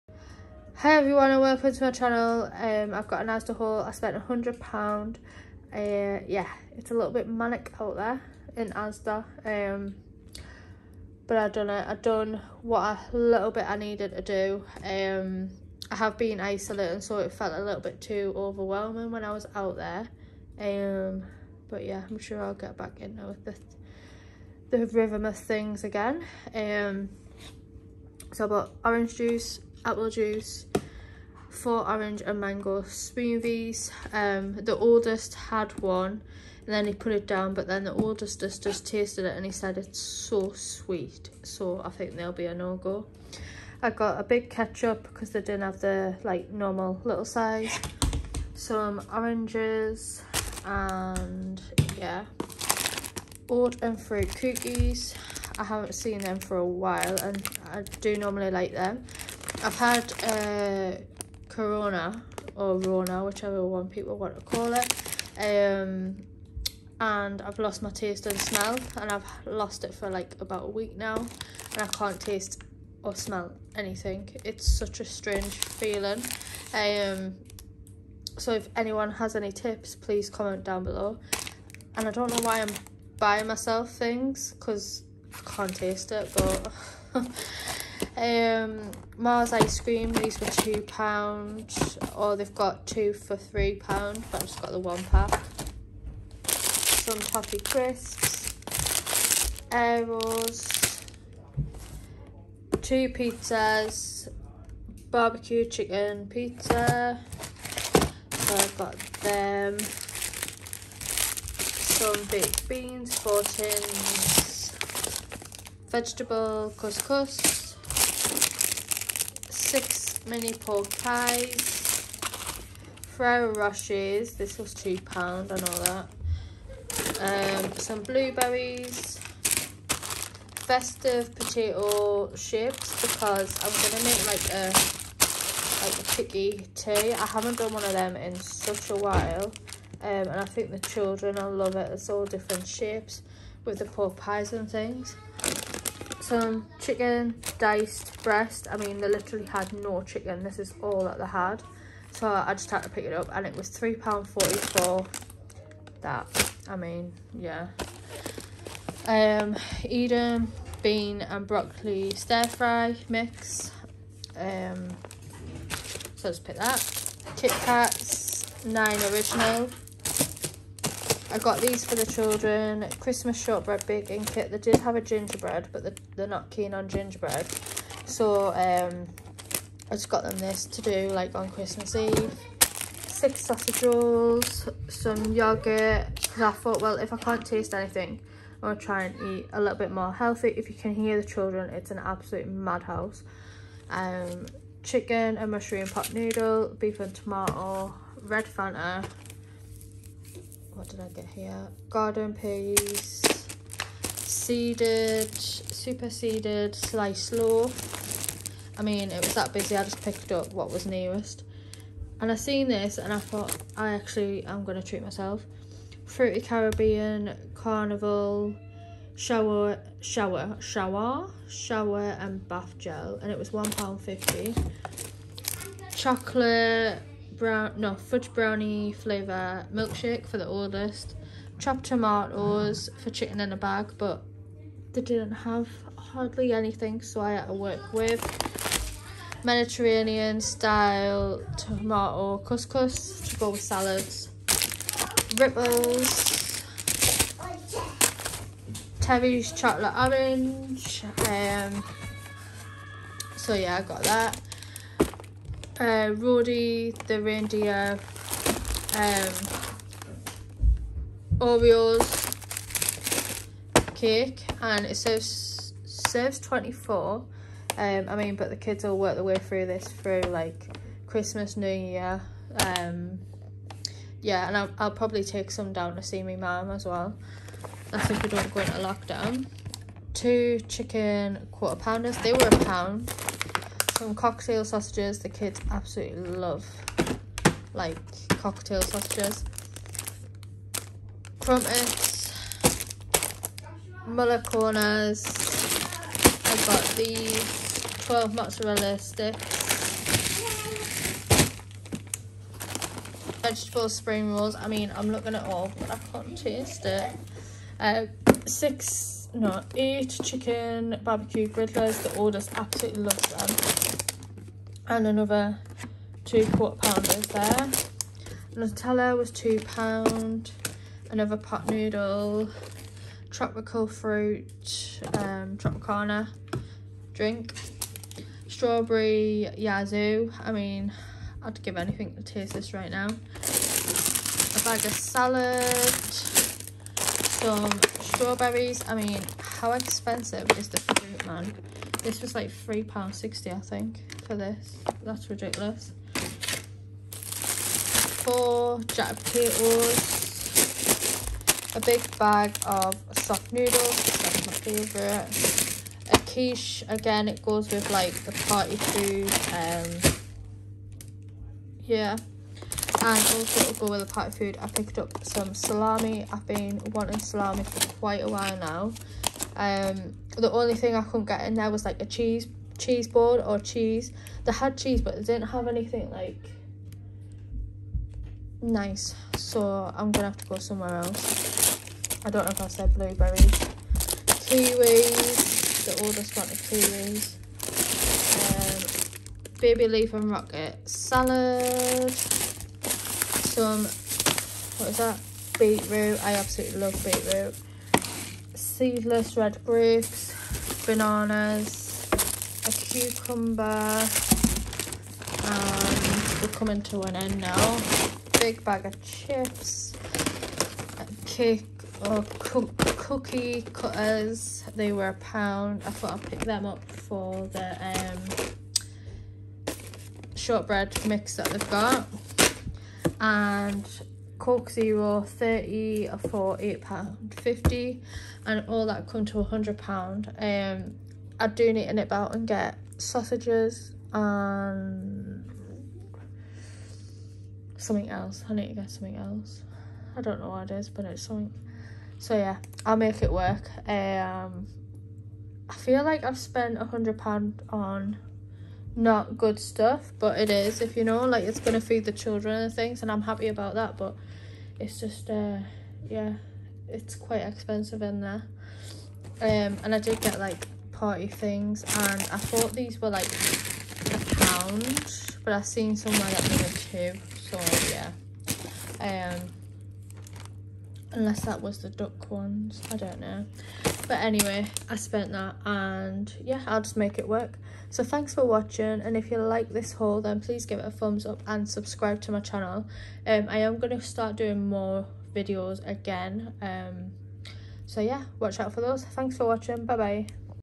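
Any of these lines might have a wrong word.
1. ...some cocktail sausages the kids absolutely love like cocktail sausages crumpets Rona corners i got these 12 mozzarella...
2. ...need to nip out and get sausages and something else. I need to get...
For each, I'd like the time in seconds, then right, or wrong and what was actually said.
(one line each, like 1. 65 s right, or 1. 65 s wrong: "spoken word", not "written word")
1. 284 s wrong: "Muller", not "Rona"
2. 431 s right.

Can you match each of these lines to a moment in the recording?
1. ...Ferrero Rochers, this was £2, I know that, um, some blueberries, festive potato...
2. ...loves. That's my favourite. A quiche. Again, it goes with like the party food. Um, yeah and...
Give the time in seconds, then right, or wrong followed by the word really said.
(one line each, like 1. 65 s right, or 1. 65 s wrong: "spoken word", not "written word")
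1. 123 s right
2. 353 s wrong: "noodles", not "loves".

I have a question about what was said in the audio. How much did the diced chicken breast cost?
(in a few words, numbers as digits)
£3.44.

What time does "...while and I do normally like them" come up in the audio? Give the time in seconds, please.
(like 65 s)
56 s.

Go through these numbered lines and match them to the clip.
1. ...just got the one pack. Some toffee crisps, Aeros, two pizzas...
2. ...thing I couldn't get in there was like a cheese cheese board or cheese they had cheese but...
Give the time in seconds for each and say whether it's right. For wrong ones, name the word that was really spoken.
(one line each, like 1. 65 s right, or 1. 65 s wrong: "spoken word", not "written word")
1. 94 s right
2. 370 s right.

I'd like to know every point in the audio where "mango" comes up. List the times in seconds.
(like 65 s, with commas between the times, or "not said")
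32 s.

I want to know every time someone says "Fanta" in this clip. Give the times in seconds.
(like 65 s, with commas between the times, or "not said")
198 s.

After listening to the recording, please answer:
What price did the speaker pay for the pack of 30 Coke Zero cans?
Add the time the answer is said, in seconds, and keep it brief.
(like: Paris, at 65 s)
£8.50, at 426 s.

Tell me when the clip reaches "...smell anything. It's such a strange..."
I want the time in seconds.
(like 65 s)
73 s.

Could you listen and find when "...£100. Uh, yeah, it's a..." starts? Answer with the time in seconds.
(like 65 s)
4 s.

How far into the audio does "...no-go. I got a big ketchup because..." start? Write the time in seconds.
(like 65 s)
42 s.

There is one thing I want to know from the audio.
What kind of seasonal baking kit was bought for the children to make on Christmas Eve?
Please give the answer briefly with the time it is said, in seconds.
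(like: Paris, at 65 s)
Christmas shortbread, at 172 s.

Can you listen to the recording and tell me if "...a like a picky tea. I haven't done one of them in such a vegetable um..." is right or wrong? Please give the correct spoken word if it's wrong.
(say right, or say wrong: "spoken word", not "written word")
wrong: "while", not "vegetable".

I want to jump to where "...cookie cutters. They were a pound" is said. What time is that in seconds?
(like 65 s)
412 s.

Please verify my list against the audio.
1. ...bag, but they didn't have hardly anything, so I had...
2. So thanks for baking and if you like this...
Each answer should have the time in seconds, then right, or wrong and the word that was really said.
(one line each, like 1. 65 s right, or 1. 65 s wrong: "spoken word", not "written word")
1. 233 s right
2. 477 s wrong: "watching", not "baking".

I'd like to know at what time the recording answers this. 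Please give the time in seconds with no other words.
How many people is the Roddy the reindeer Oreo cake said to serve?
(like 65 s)
266 s.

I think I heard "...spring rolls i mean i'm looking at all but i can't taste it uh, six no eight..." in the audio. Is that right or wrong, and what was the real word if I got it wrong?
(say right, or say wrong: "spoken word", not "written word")
right.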